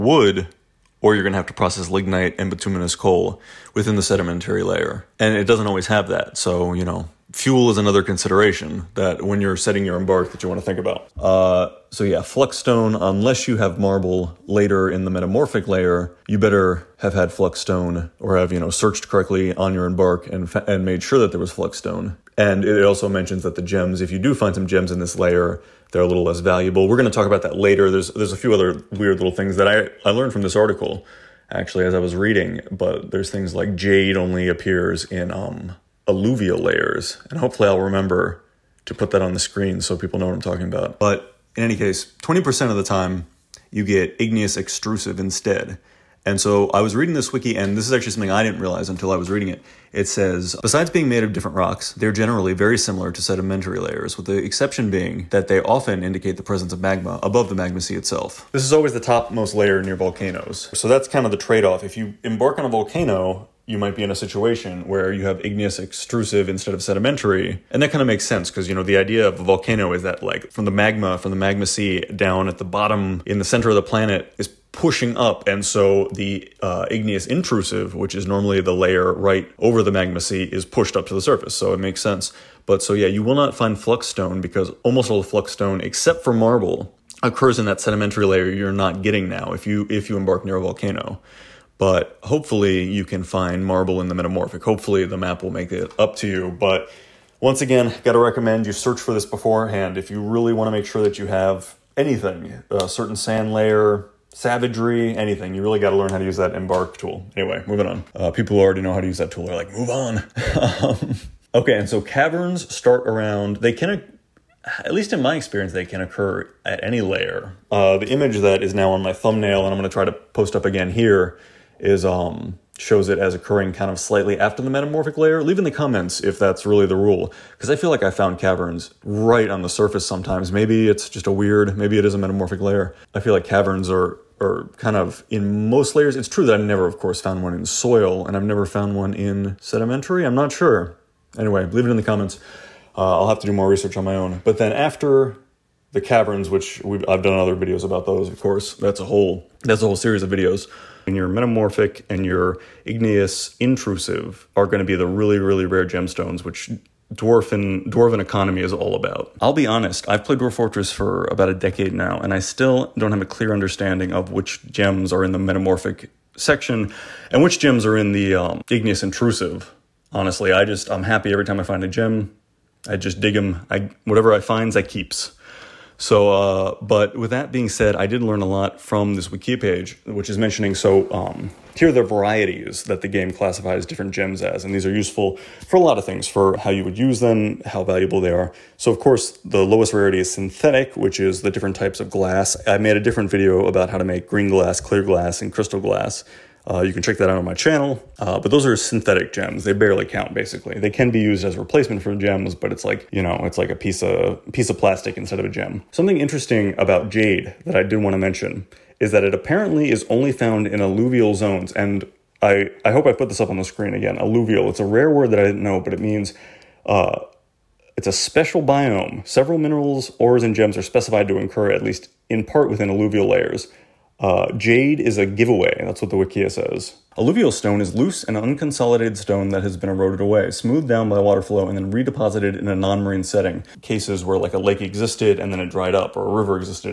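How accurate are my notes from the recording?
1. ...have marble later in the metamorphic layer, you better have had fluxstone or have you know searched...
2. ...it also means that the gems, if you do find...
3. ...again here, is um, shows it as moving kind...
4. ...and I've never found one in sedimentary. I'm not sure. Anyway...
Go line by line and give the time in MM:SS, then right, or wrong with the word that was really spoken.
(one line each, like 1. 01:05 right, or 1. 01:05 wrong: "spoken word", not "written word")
1. 00:13 right
2. 00:22 wrong: "mentions", not "means"
3. 02:00 wrong: "occurring", not "moving"
4. 02:18 right.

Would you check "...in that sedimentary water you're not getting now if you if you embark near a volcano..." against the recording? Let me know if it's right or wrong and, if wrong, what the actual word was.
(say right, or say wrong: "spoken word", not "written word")
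wrong: "layer", not "water".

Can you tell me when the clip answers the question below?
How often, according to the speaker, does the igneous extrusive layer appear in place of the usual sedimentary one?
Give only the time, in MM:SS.
00:42.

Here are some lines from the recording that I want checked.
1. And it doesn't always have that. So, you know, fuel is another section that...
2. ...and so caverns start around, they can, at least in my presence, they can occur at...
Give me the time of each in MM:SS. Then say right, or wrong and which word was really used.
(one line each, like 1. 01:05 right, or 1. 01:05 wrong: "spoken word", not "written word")
1. 00:05 wrong: "consideration", not "section"
2. 01:51 wrong: "experience", not "presence".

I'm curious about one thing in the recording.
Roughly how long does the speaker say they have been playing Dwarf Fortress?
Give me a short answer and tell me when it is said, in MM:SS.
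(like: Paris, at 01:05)
About a decade, at 02:41.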